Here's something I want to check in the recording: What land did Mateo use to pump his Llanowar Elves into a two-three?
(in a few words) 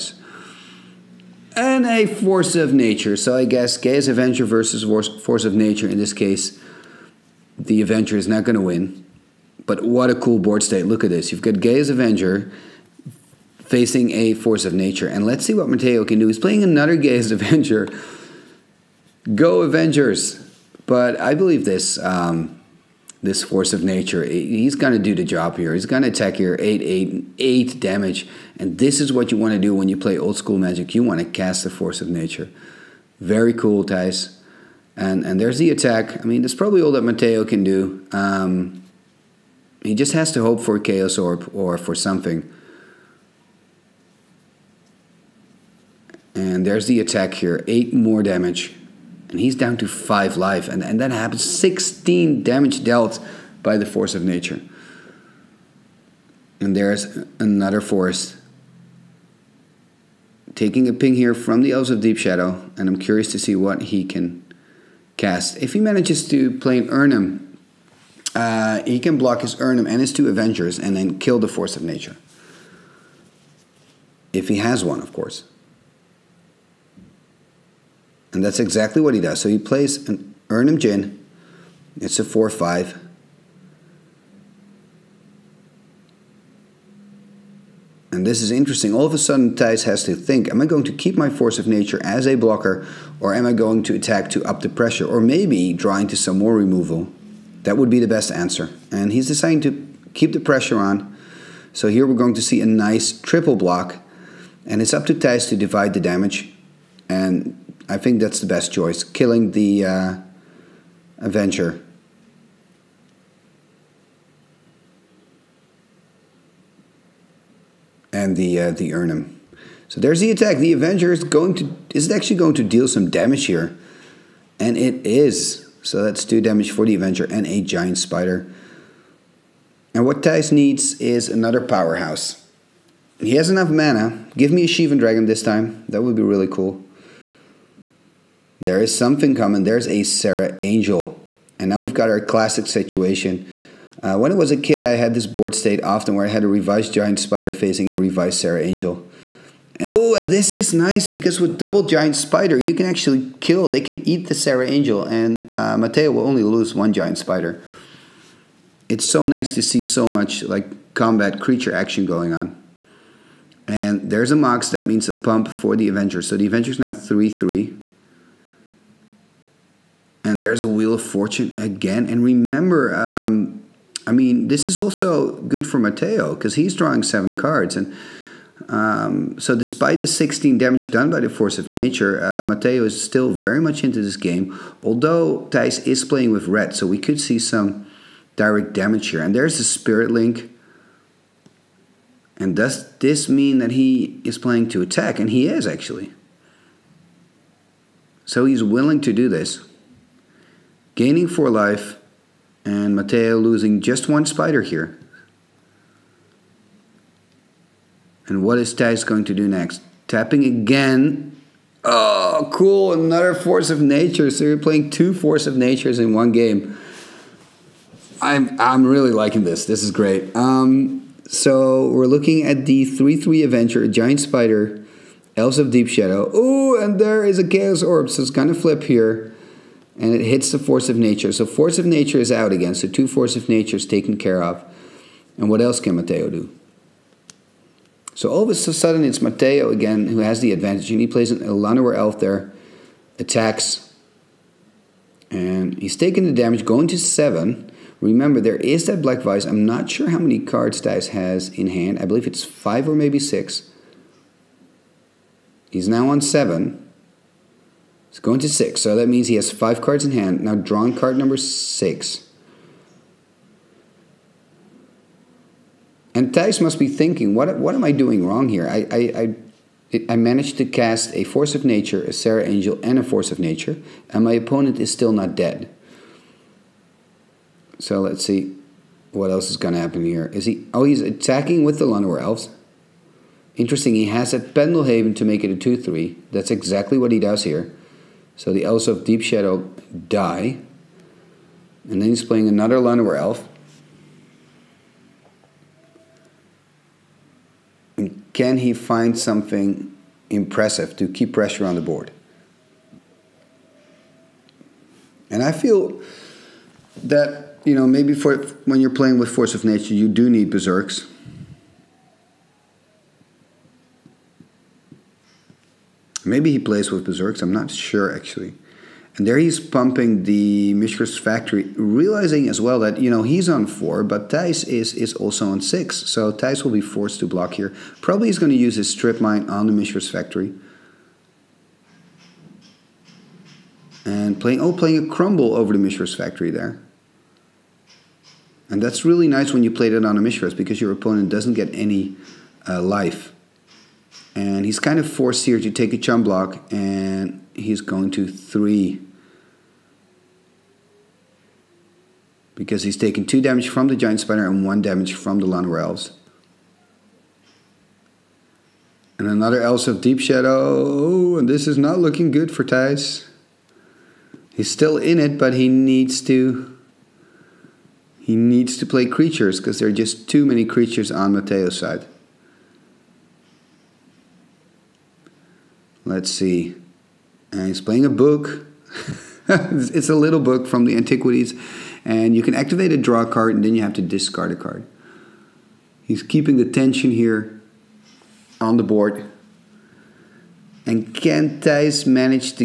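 Pendelhaven.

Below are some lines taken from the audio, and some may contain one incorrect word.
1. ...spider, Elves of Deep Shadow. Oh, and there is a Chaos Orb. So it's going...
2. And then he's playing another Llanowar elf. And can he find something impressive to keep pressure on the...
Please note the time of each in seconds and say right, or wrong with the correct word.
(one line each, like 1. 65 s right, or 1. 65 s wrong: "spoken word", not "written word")
1. 224 s right
2. 291 s right.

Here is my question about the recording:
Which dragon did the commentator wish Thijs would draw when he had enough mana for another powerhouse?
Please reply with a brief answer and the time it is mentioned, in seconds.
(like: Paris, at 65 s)
Shivan Dragon, at 134 s.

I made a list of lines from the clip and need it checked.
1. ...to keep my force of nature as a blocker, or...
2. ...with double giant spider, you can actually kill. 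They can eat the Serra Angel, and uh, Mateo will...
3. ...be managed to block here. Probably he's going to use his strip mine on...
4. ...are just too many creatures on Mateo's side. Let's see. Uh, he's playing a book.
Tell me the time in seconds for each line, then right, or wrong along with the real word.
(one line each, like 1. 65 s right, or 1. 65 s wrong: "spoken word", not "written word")
1. 90 s right
2. 151 s right
3. 326 s wrong: "forced", not "managed"
4. 369 s right.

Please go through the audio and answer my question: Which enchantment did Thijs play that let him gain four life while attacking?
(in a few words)
Spirit Link.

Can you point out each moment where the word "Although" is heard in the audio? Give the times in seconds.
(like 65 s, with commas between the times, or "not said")
184 s.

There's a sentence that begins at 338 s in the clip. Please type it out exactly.
And that's really nice when you played it on a Mishra's because your opponent doesn't get any uh, life.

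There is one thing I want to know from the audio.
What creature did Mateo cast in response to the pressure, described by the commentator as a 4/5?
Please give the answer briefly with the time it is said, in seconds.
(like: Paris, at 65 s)
Erhnam Djinn, at 80 s.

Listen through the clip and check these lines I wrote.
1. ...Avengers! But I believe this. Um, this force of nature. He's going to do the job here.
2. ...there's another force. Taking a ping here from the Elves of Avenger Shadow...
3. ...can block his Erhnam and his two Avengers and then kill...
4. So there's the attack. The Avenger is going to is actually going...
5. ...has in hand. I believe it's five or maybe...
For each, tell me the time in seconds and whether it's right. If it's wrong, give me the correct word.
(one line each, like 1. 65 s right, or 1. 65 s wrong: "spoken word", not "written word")
1. 19 s right
2. 56 s wrong: "Deep", not "Avenger"
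3. 68 s right
4. 119 s right
5. 251 s right.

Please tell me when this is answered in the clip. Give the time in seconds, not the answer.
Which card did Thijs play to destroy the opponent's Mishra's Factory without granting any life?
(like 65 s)
335 s.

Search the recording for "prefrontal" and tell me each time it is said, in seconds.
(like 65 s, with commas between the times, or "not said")
not said.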